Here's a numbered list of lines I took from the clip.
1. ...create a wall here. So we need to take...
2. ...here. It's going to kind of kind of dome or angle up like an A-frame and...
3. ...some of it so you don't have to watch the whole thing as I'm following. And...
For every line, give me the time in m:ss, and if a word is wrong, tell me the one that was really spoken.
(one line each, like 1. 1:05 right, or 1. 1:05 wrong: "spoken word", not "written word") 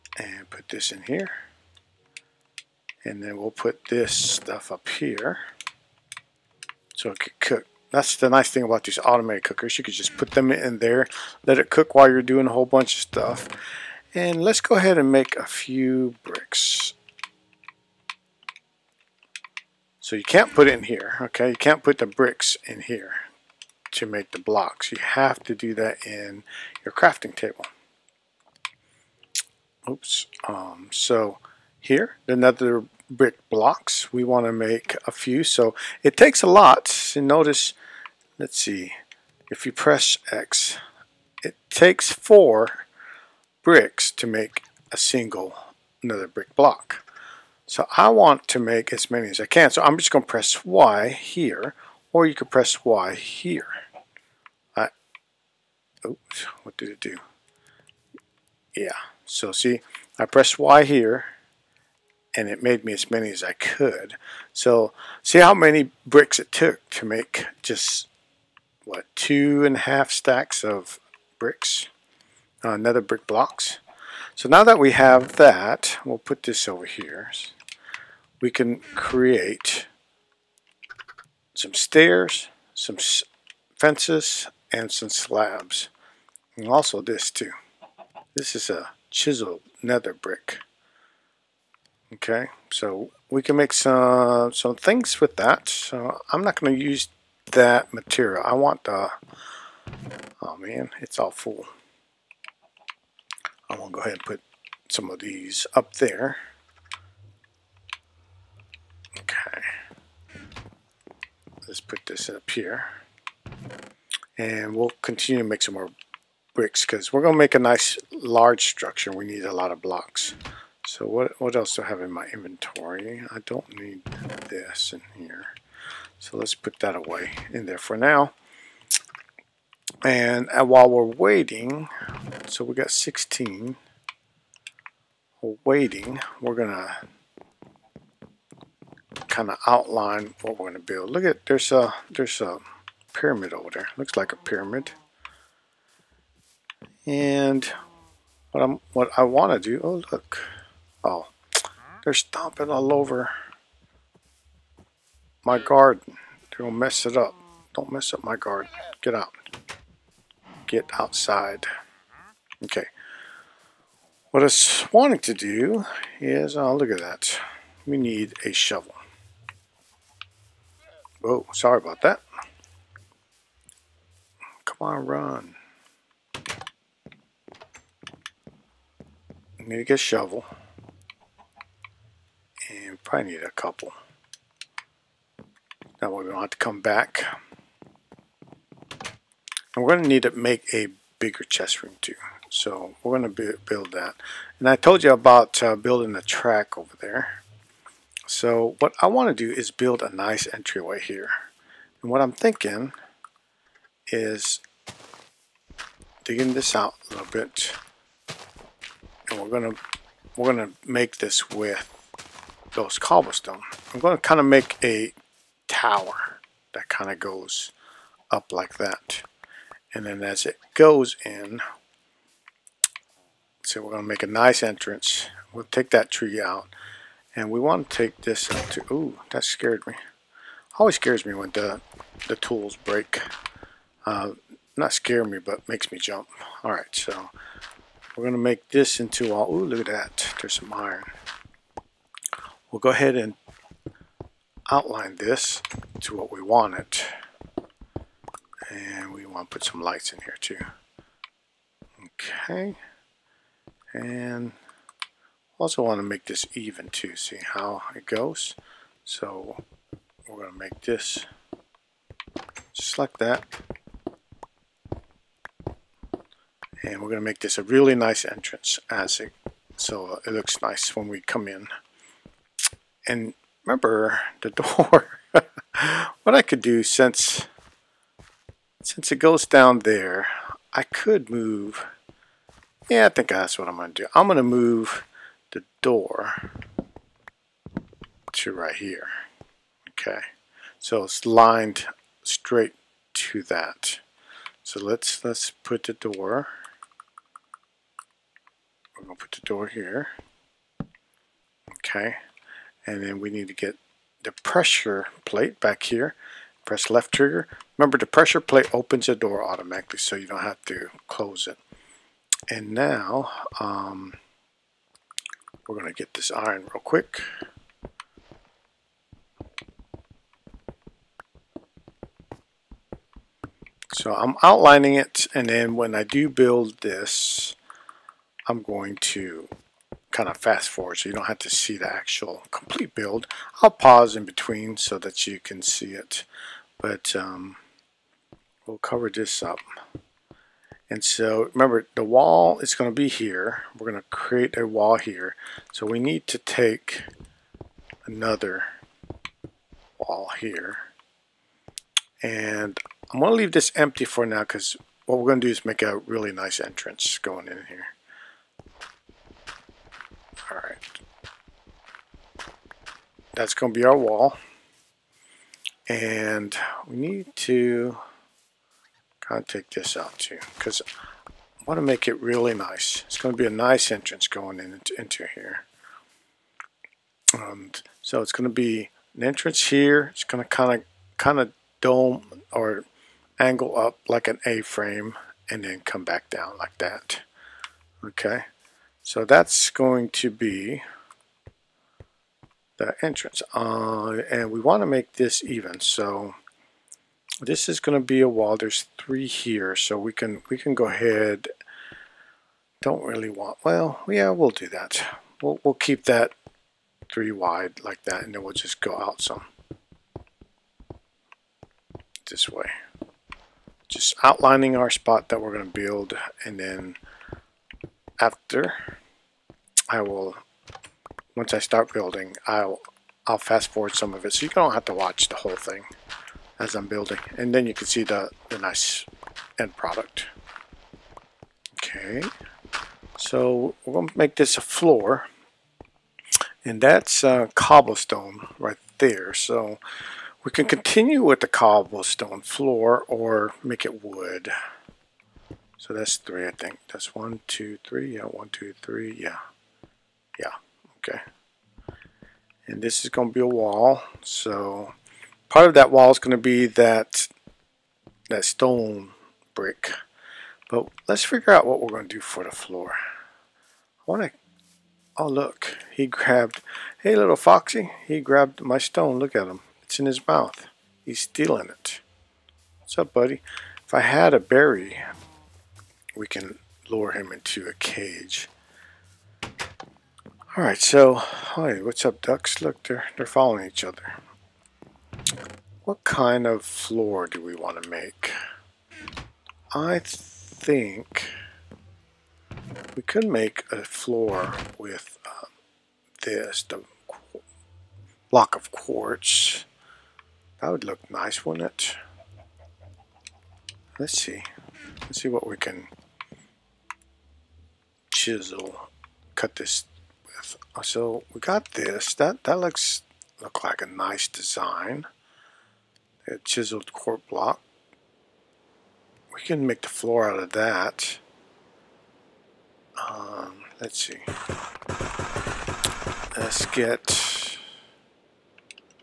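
1. 5:44 right
2. 6:19 right
3. 7:03 wrong: "building", not "following".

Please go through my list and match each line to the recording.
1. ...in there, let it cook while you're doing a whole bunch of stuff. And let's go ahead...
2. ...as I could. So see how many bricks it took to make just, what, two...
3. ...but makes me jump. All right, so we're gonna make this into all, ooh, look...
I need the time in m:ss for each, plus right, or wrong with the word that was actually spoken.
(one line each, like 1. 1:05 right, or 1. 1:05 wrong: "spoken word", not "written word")
1. 0:10 right
2. 1:03 right
3. 3:55 right.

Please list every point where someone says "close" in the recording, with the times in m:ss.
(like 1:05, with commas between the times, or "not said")
5:11.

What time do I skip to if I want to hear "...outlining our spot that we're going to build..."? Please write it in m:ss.
6:54.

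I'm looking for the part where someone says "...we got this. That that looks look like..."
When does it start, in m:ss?
8:31.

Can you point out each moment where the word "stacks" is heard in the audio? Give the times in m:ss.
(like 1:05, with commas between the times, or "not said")
1:10.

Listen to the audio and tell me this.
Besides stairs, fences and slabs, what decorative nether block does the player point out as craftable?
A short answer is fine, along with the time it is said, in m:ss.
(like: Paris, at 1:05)
chiseled nether brick, at 1:29.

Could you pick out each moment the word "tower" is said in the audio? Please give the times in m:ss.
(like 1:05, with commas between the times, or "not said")
3:35.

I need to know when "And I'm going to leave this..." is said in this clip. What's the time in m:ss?
5:52.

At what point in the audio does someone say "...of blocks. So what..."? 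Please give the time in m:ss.
1:59.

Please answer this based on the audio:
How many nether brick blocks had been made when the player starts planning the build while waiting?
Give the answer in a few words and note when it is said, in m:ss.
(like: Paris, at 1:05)
16, at 2:12.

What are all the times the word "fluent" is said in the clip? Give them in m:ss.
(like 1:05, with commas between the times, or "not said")
not said.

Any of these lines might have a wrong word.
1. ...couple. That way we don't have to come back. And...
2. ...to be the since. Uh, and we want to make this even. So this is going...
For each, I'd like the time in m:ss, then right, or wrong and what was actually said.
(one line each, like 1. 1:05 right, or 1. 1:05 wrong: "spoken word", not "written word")
1. 3:03 right
2. 6:30 wrong: "entrance", not "since".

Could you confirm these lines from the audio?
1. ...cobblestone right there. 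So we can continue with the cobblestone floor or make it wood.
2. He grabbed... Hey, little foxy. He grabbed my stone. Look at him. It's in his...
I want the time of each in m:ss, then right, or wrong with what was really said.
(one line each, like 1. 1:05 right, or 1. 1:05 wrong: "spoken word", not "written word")
1. 7:17 right
2. 7:45 right.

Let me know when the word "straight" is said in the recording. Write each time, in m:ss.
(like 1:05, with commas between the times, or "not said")
4:52.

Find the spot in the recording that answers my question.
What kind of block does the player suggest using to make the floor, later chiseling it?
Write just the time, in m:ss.
8:18.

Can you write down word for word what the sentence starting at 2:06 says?
So let's put that away in there for now.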